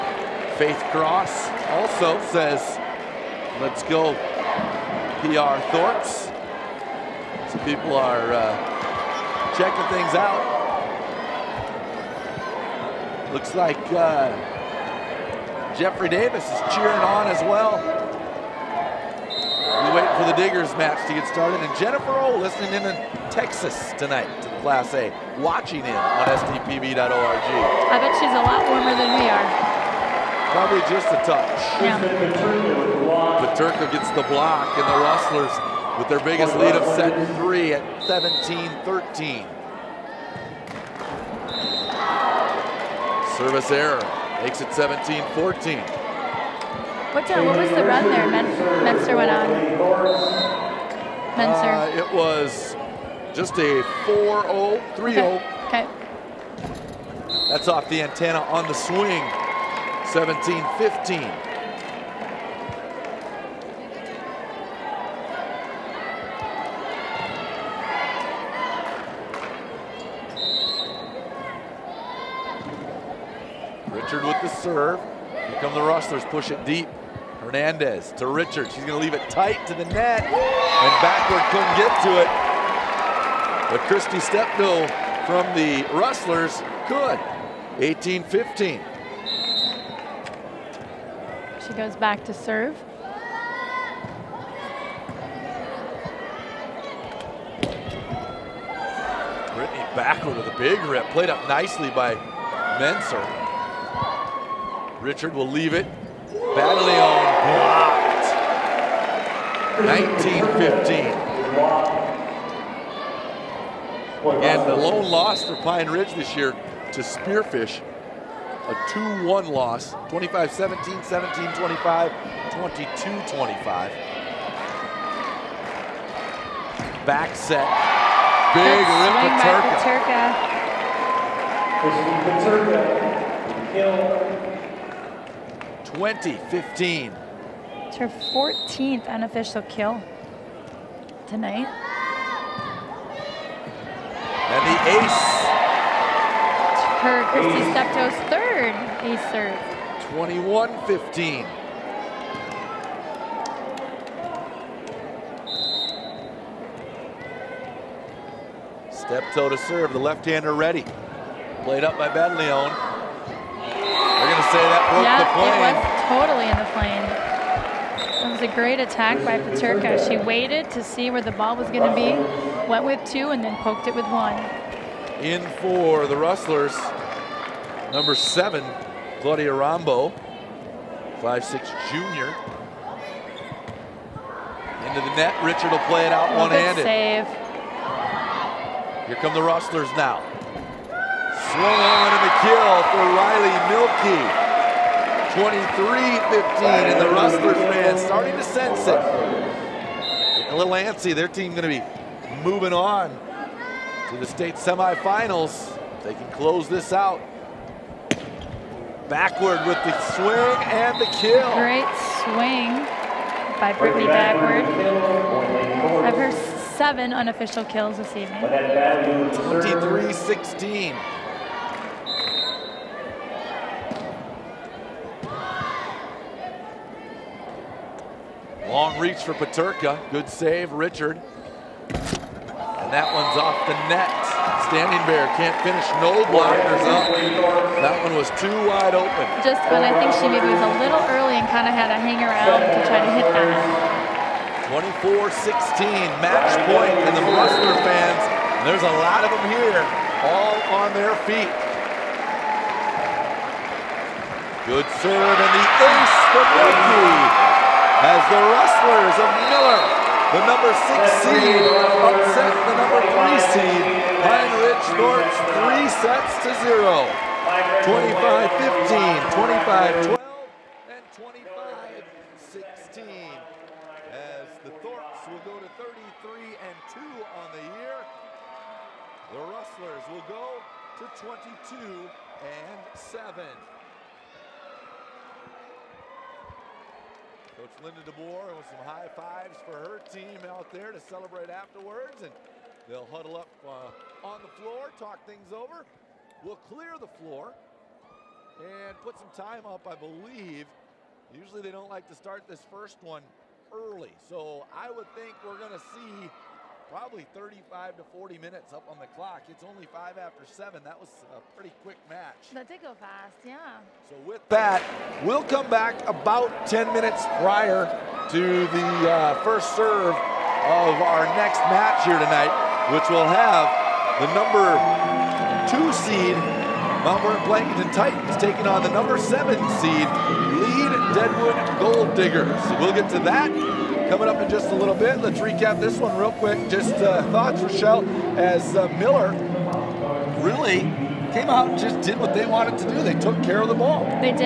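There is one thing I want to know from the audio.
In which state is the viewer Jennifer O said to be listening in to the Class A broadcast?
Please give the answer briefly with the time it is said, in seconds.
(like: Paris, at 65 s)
Texas, at 23 s.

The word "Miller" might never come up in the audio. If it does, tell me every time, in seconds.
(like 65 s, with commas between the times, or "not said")
259 s, 338 s.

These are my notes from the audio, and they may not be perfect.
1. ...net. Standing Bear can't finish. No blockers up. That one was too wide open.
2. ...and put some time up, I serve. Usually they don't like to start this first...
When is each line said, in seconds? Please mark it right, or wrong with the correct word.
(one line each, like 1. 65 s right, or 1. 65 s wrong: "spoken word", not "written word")
1. 233 s right
2. 298 s wrong: "believe", not "serve".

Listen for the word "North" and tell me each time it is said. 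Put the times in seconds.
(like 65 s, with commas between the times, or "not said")
264 s.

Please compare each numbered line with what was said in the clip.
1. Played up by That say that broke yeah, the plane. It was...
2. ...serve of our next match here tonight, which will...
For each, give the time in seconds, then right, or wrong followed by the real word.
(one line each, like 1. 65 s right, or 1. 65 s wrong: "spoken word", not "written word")
1. 161 s wrong: "Leone", not "That"
2. 319 s right.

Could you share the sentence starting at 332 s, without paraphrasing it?
We'll get to that coming up in just a little bit.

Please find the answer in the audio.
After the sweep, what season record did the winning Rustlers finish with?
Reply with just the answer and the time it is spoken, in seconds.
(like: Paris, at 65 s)
22 and 7, at 281 s.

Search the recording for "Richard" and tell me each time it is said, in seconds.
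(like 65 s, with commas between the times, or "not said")
74 s, 78 s, 105 s, 185 s, 230 s.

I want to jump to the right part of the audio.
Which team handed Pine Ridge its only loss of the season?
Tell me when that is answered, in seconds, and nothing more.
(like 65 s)
116 s.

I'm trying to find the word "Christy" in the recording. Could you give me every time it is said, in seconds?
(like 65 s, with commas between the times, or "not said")
83 s, 147 s.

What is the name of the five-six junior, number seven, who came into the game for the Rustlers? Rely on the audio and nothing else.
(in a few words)
Claudia Rambo.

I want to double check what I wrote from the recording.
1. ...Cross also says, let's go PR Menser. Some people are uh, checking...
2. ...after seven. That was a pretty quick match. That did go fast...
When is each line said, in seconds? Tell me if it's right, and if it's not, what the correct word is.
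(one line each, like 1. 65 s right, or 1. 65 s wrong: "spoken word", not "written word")
1. 0 s wrong: "Thorpes", not "Menser"
2. 310 s right.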